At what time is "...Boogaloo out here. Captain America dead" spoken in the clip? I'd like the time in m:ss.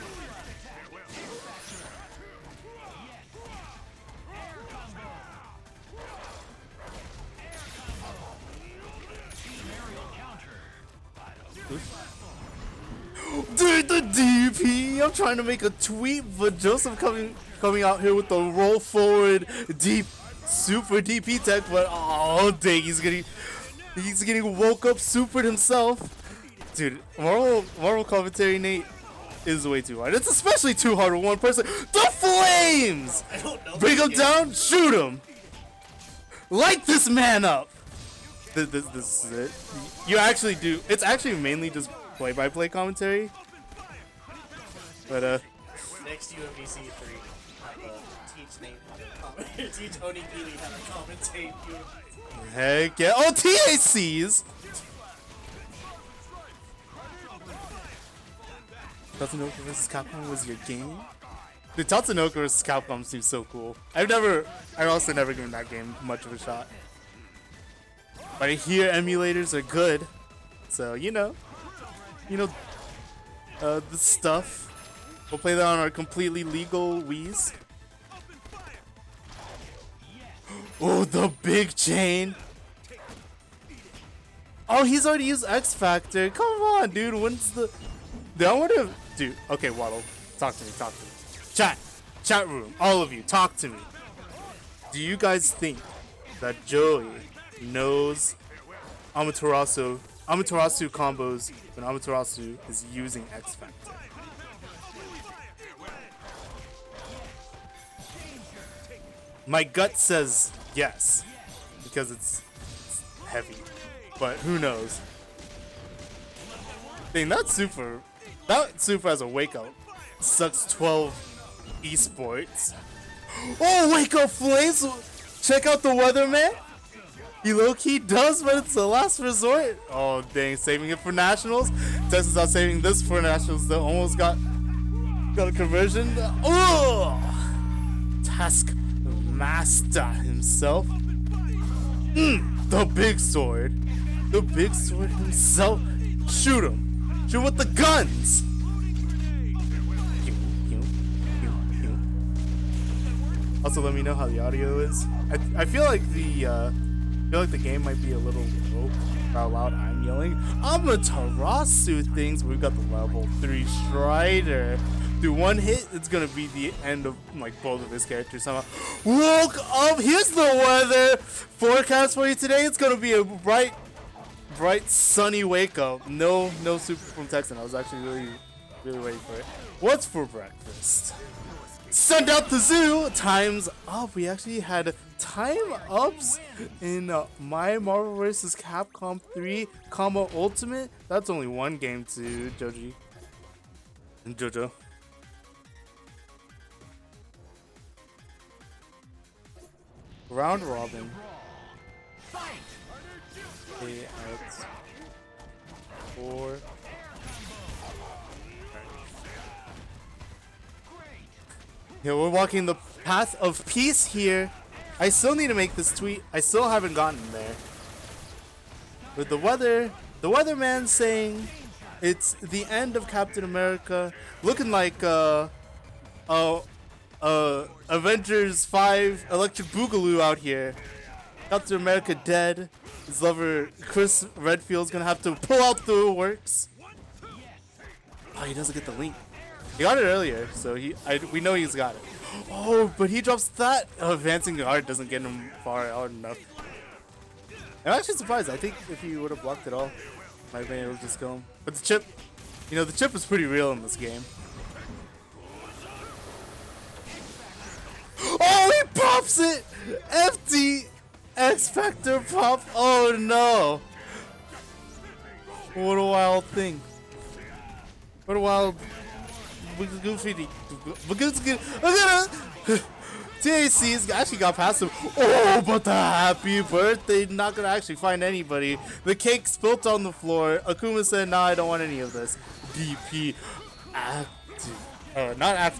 3:49.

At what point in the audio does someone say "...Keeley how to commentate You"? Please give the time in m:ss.
0:50.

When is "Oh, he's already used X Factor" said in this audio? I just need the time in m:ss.
1:24.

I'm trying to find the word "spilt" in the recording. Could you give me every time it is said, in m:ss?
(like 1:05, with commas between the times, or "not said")
4:39.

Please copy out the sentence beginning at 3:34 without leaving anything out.
I still need to make this tweet.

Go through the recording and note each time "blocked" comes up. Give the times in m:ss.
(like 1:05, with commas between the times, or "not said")
4:09.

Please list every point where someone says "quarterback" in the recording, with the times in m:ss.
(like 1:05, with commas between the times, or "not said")
not said.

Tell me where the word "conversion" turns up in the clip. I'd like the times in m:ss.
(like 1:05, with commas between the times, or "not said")
2:15.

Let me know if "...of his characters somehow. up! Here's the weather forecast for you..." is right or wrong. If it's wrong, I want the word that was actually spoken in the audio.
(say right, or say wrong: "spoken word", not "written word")
right.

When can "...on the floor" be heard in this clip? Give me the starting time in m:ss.
4:39.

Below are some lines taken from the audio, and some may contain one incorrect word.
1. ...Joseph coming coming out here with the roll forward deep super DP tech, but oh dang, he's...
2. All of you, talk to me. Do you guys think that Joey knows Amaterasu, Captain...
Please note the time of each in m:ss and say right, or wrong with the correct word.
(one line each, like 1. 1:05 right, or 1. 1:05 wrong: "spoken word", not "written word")
1. 0:16 right
2. 1:32 wrong: "Amaterasu", not "Captain".